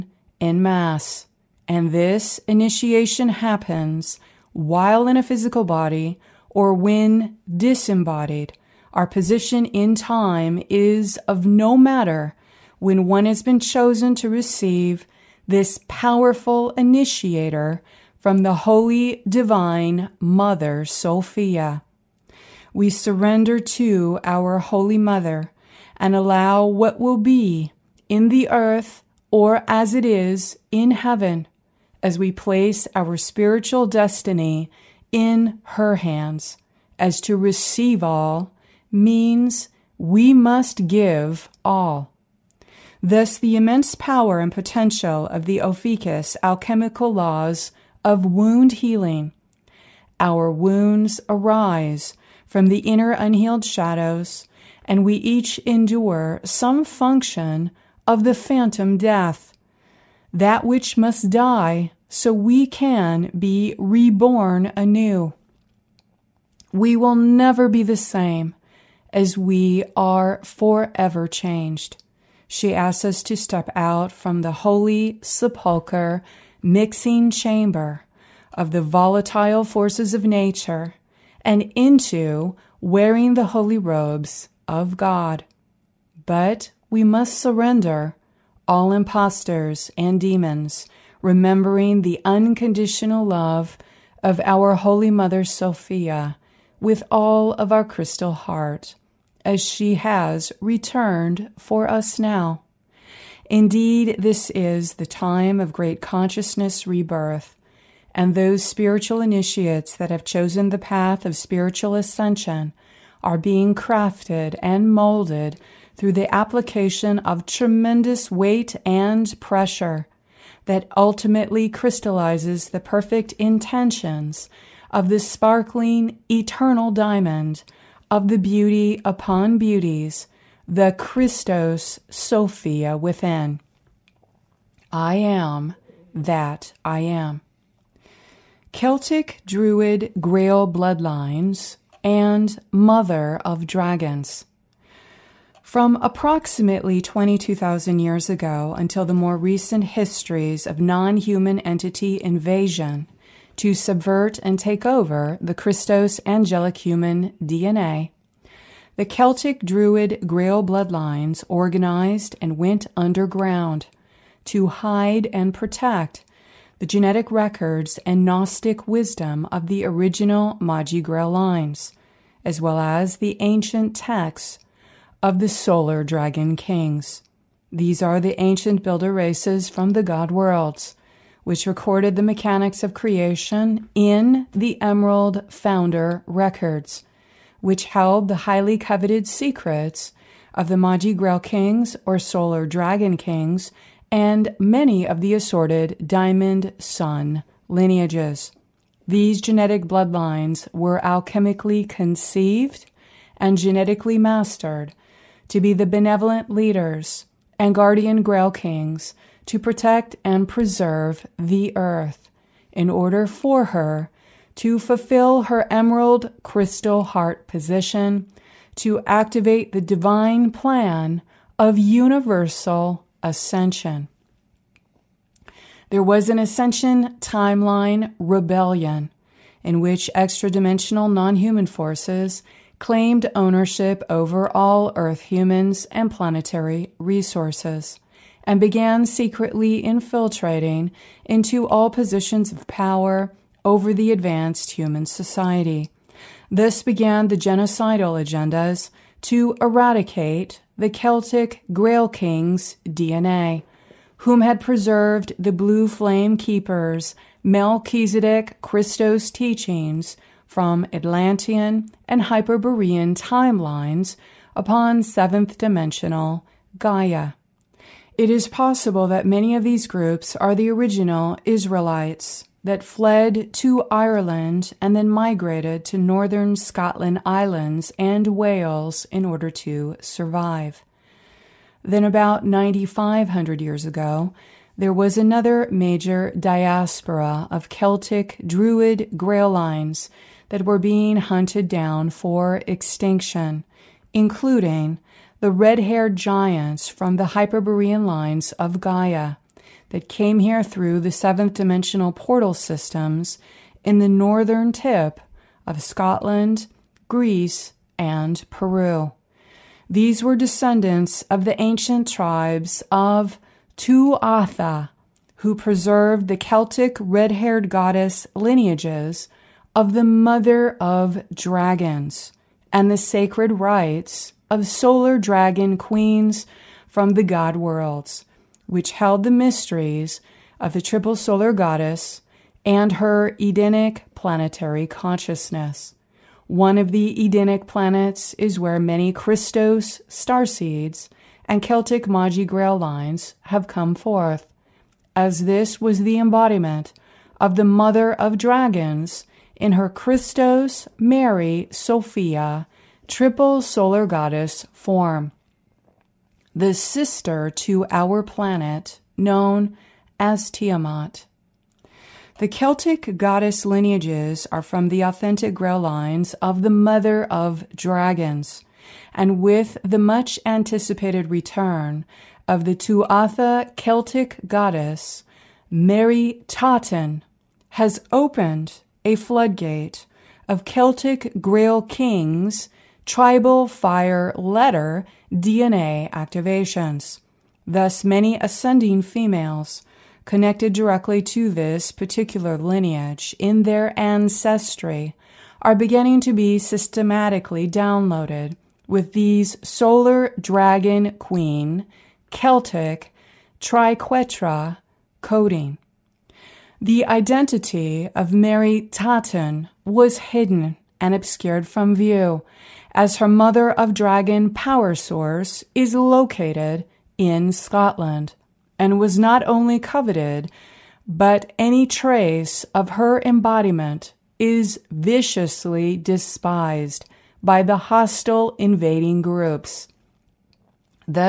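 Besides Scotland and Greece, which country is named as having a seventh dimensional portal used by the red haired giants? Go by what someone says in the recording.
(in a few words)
Peru.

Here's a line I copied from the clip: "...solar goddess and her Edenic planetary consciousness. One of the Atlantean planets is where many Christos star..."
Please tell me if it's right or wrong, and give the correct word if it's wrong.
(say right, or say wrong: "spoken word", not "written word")
wrong: "Edenic", not "Atlantean".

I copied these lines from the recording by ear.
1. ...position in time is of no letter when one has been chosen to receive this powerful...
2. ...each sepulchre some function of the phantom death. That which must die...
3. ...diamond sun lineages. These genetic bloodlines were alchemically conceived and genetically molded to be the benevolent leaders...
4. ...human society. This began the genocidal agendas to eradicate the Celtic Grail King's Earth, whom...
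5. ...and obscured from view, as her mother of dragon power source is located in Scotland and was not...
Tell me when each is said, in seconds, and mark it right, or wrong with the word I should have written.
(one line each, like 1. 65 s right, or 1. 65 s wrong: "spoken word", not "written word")
1. 9 s wrong: "matter", not "letter"
2. 55 s wrong: "endure", not "sepulchre"
3. 196 s wrong: "mastered", not "molded"
4. 244 s wrong: "DNA", not "Earth"
5. 410 s right.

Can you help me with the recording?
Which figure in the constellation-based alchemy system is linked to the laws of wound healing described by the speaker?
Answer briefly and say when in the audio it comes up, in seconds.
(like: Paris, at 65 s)
Ophiuchus, at 45 s.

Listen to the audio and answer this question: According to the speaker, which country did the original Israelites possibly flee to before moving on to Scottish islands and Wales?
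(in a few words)
Ireland.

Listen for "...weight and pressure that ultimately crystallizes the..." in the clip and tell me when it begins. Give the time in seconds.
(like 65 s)
118 s.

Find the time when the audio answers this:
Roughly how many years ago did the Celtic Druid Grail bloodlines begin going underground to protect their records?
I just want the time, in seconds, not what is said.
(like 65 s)
146 s.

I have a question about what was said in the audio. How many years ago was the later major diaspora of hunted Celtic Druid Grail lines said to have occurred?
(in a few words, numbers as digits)
9,500.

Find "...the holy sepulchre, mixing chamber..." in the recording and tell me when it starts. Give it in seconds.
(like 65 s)
74 s.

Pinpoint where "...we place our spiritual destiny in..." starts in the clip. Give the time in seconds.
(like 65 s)
32 s.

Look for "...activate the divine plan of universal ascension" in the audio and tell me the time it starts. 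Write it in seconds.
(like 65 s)
219 s.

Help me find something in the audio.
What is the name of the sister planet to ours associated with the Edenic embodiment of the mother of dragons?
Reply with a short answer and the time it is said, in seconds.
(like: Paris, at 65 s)
Tiamat, at 360 s.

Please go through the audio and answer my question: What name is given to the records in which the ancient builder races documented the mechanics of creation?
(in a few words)
Emerald Founder records.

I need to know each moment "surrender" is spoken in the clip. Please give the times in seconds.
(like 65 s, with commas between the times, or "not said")
22 s, 87 s.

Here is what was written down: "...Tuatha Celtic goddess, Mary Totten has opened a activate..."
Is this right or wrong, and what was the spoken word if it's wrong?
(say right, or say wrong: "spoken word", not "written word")
wrong: "floodgate", not "activate".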